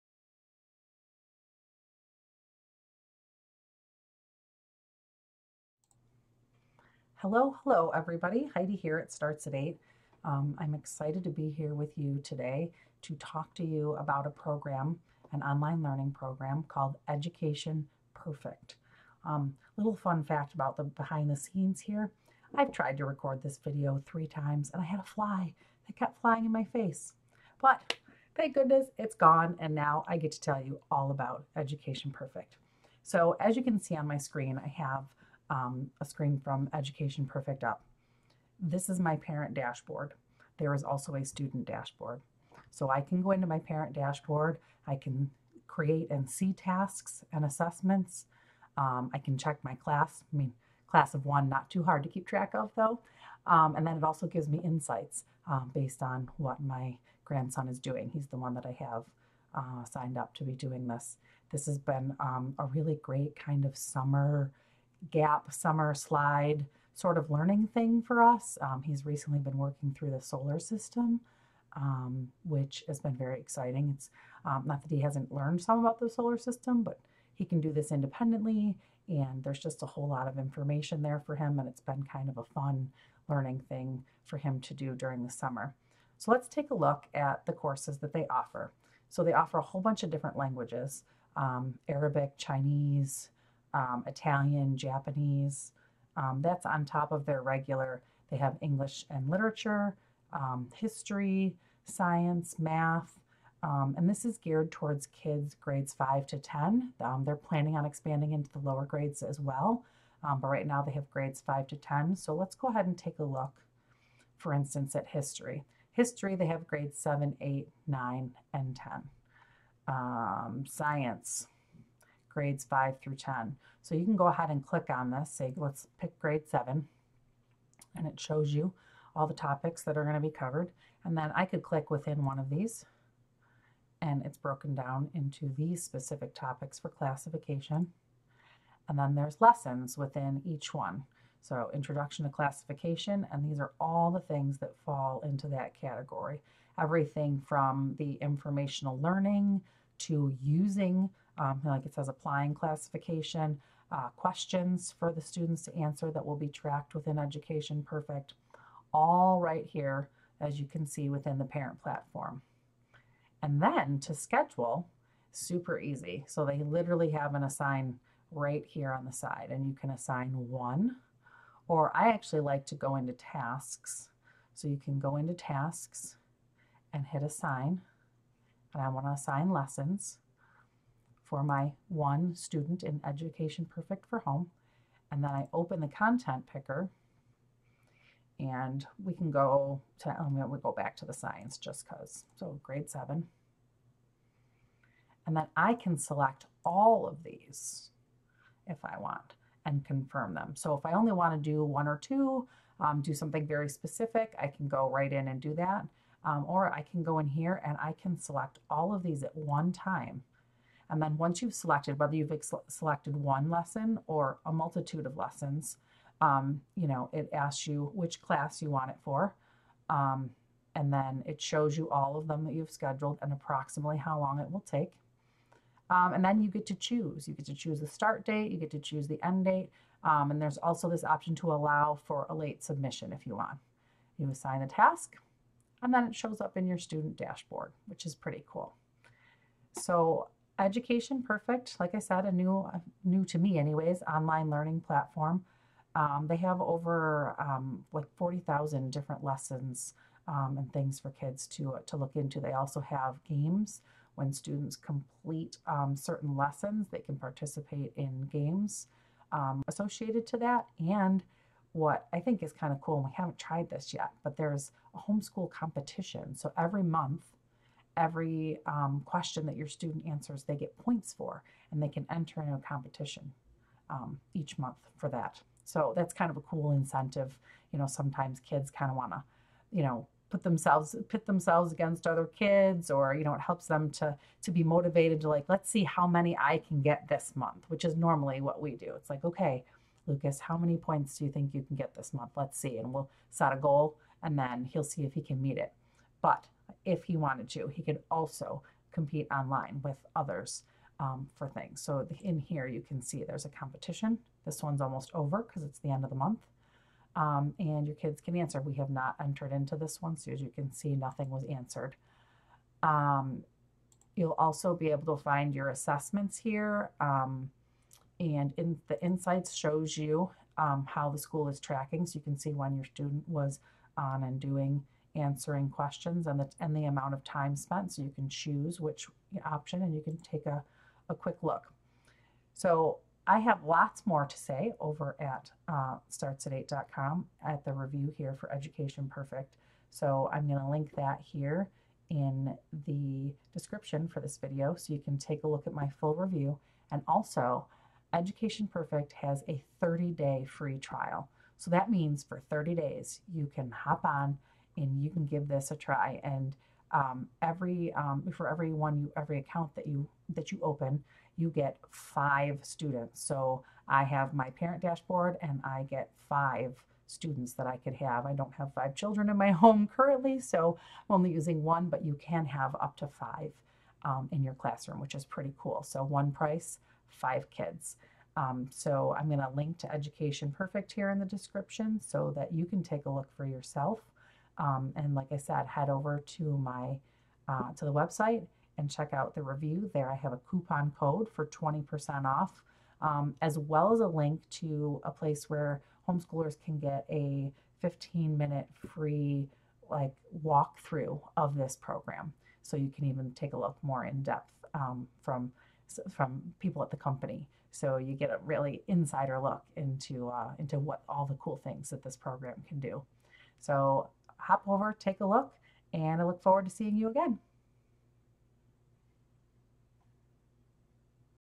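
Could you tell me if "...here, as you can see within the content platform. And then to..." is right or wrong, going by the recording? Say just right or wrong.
wrong.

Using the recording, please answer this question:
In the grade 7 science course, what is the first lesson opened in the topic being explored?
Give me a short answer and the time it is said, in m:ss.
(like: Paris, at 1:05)
Introduction to classification, at 2:21.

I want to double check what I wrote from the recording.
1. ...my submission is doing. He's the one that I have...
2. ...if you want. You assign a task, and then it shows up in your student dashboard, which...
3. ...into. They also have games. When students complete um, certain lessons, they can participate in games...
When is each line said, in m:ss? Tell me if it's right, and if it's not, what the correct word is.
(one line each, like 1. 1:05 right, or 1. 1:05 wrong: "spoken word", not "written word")
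1. 0:56 wrong: "grandson", not "submission"
2. 3:53 right
3. 4:12 right.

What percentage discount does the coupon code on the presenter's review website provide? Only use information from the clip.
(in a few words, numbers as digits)
20%.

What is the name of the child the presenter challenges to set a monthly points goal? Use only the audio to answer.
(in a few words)
Lucas.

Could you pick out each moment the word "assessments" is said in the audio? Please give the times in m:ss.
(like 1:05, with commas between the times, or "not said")
0:47, 5:15.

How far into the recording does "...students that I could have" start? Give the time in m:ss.
6:07.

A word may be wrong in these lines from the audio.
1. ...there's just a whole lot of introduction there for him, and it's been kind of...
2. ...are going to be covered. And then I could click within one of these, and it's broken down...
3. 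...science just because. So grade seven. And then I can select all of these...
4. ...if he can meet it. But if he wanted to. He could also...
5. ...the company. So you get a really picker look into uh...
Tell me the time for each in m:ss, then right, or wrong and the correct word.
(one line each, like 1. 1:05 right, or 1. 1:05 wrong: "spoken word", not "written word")
1. 1:19 wrong: "information", not "introduction"
2. 2:09 right
3. 3:11 right
4. 4:55 right
5. 6:46 wrong: "insider", not "picker".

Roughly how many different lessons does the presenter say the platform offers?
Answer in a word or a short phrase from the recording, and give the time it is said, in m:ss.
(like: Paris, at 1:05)
40,000, at 4:08.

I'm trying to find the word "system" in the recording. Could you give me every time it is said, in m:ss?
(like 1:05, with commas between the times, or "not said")
1:10, 1:16.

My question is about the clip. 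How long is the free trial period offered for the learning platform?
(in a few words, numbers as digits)
30 days.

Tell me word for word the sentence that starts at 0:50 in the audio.
I mean, class of one, not too hard to keep track of though.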